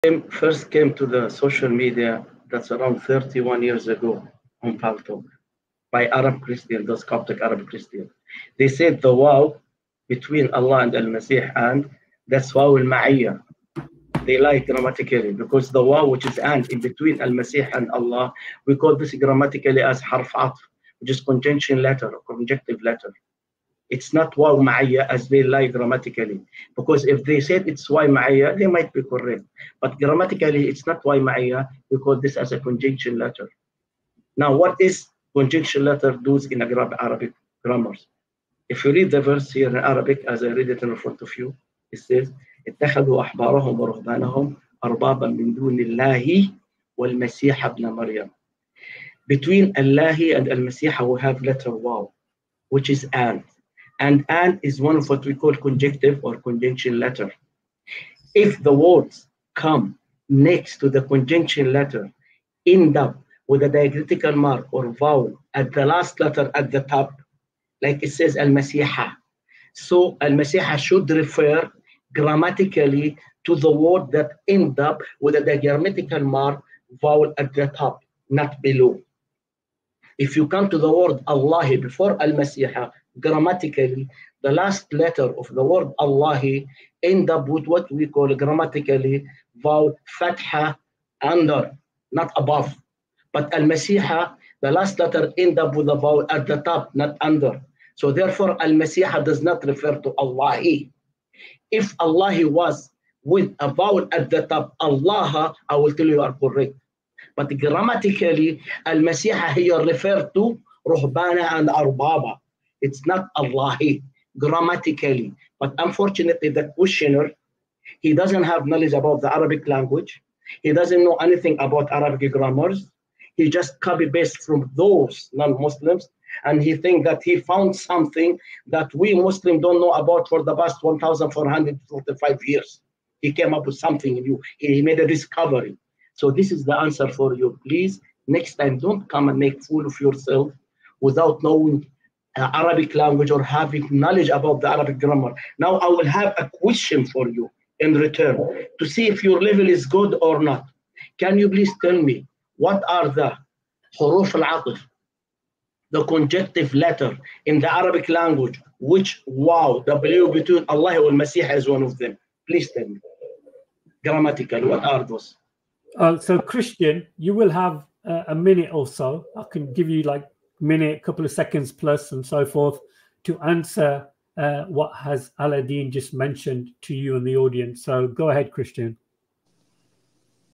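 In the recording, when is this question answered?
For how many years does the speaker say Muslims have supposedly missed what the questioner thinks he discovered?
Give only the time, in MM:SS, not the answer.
02:10.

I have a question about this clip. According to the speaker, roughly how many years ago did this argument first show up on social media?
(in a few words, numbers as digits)
31 years.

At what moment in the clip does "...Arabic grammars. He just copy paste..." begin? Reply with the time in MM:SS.
02:01.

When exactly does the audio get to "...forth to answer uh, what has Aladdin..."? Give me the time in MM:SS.
02:52.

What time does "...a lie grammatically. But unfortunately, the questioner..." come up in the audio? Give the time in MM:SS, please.
01:53.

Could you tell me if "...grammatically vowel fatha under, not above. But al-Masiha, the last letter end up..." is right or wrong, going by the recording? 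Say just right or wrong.
right.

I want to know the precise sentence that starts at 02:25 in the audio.
Now I will have a question for you in return to see if your level is good or not.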